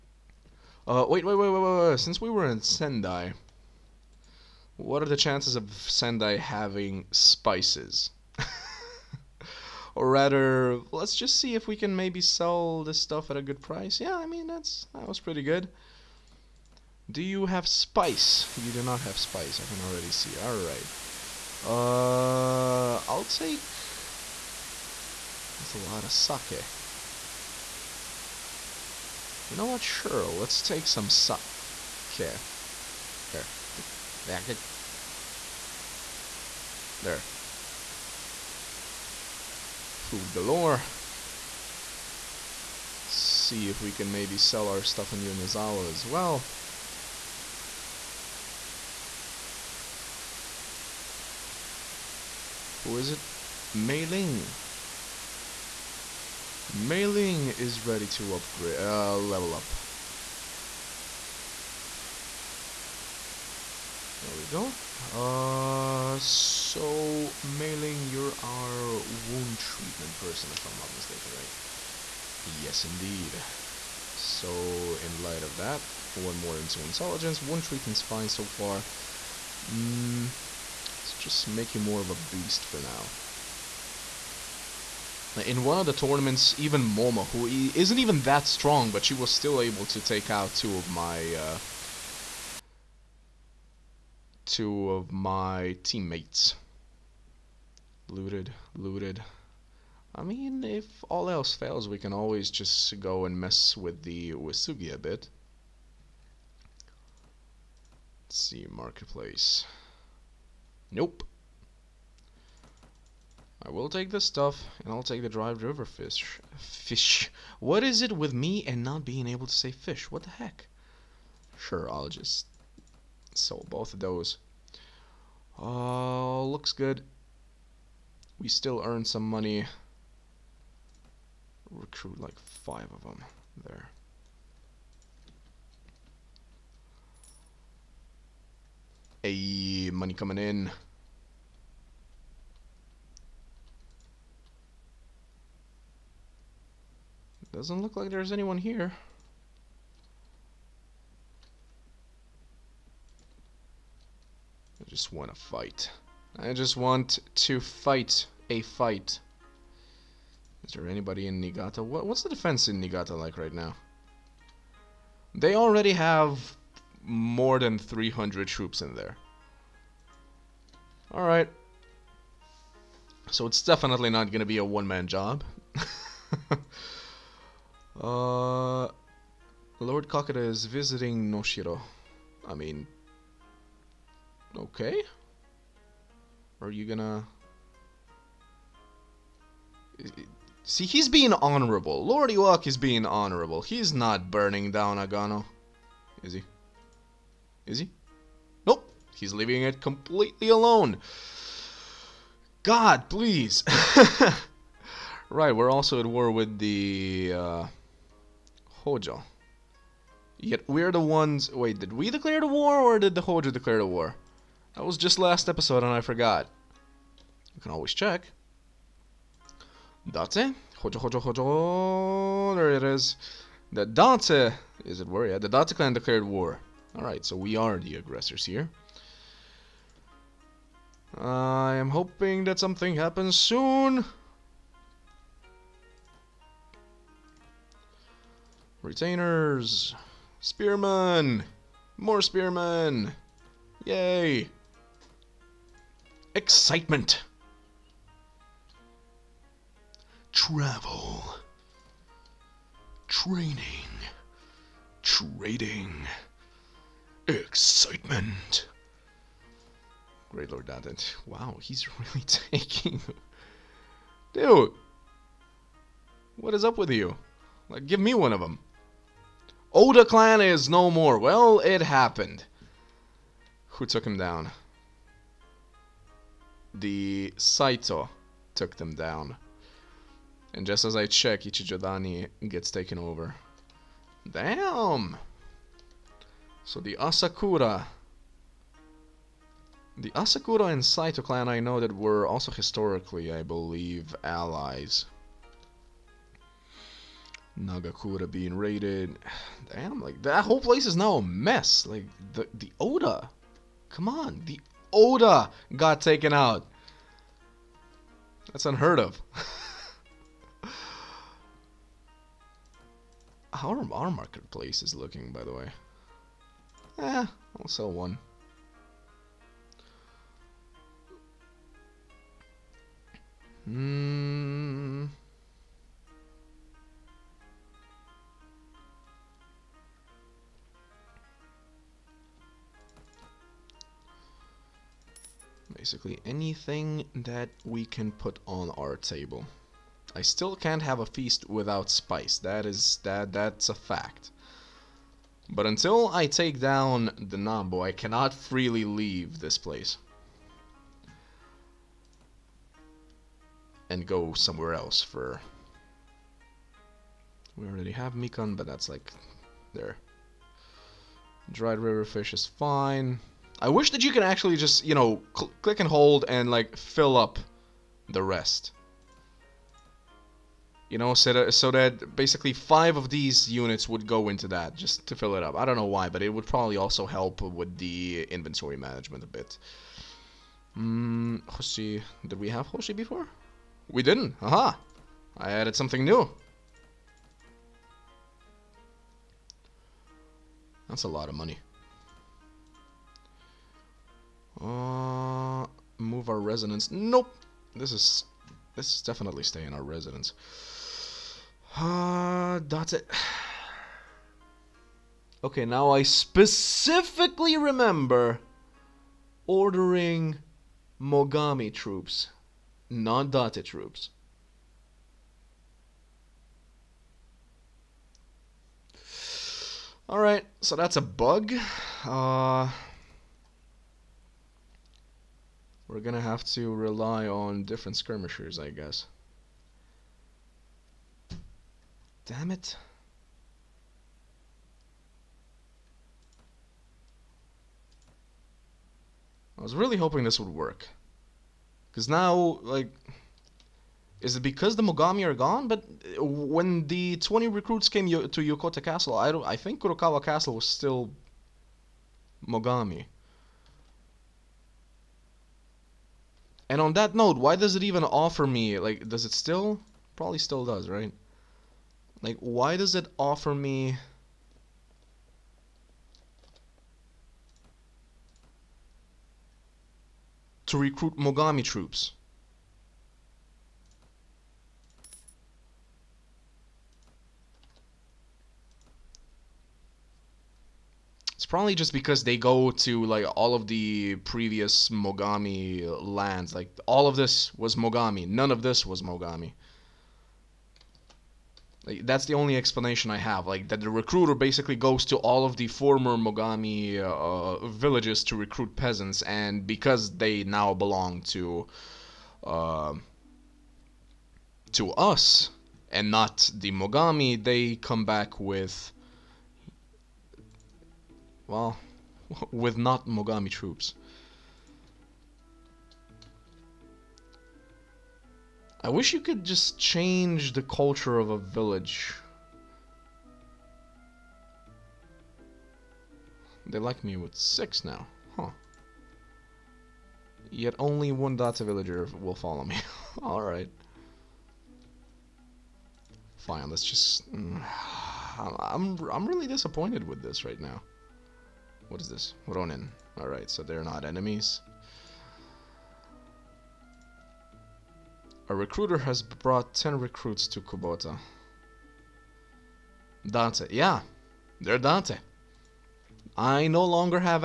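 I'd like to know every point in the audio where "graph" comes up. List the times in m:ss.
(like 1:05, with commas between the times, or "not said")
not said.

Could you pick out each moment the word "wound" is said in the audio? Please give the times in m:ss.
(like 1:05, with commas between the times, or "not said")
1:08, 1:17.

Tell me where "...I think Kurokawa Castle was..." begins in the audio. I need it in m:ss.
7:29.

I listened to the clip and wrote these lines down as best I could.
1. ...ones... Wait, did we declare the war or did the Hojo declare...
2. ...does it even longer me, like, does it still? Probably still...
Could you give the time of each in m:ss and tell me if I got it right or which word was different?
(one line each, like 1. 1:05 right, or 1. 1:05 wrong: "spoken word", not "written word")
1. 3:31 right
2. 7:37 wrong: "offer", not "longer".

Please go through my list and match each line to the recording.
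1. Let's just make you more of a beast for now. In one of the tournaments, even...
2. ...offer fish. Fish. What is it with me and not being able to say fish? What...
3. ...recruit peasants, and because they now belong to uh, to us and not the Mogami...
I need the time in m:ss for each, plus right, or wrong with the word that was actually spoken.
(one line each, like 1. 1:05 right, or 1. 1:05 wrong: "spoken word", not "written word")
1. 1:21 right
2. 1:55 wrong: "river", not "offer"
3. 8:18 right.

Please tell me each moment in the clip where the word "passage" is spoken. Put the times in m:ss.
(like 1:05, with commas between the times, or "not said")
not said.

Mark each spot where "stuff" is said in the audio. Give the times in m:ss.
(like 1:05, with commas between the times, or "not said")
0:13, 0:44, 1:54.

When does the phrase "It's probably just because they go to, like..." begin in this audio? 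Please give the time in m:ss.
8:01.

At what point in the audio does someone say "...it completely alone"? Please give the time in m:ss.
3:19.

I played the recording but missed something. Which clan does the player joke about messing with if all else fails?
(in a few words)
Uesugi.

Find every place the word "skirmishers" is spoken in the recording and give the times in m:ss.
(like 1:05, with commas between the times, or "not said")
7:07.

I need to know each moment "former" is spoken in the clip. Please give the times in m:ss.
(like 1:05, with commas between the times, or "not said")
8:15.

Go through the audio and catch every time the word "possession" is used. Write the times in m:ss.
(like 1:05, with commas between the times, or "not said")
not said.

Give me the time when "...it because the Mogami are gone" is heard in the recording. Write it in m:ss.
7:24.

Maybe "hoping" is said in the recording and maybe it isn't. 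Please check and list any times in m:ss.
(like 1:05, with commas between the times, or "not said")
3:51, 7:19.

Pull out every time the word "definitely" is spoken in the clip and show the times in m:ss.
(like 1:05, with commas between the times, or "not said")
2:53, 6:39.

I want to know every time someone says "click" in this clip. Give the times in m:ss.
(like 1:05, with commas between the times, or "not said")
6:05.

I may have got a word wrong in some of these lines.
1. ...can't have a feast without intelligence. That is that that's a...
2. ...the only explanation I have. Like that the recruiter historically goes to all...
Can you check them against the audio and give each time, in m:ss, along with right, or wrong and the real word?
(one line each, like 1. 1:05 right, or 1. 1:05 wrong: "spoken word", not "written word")
1. 5:40 wrong: "spice", not "intelligence"
2. 8:12 wrong: "basically", not "historically".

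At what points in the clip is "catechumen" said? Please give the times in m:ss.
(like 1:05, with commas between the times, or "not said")
not said.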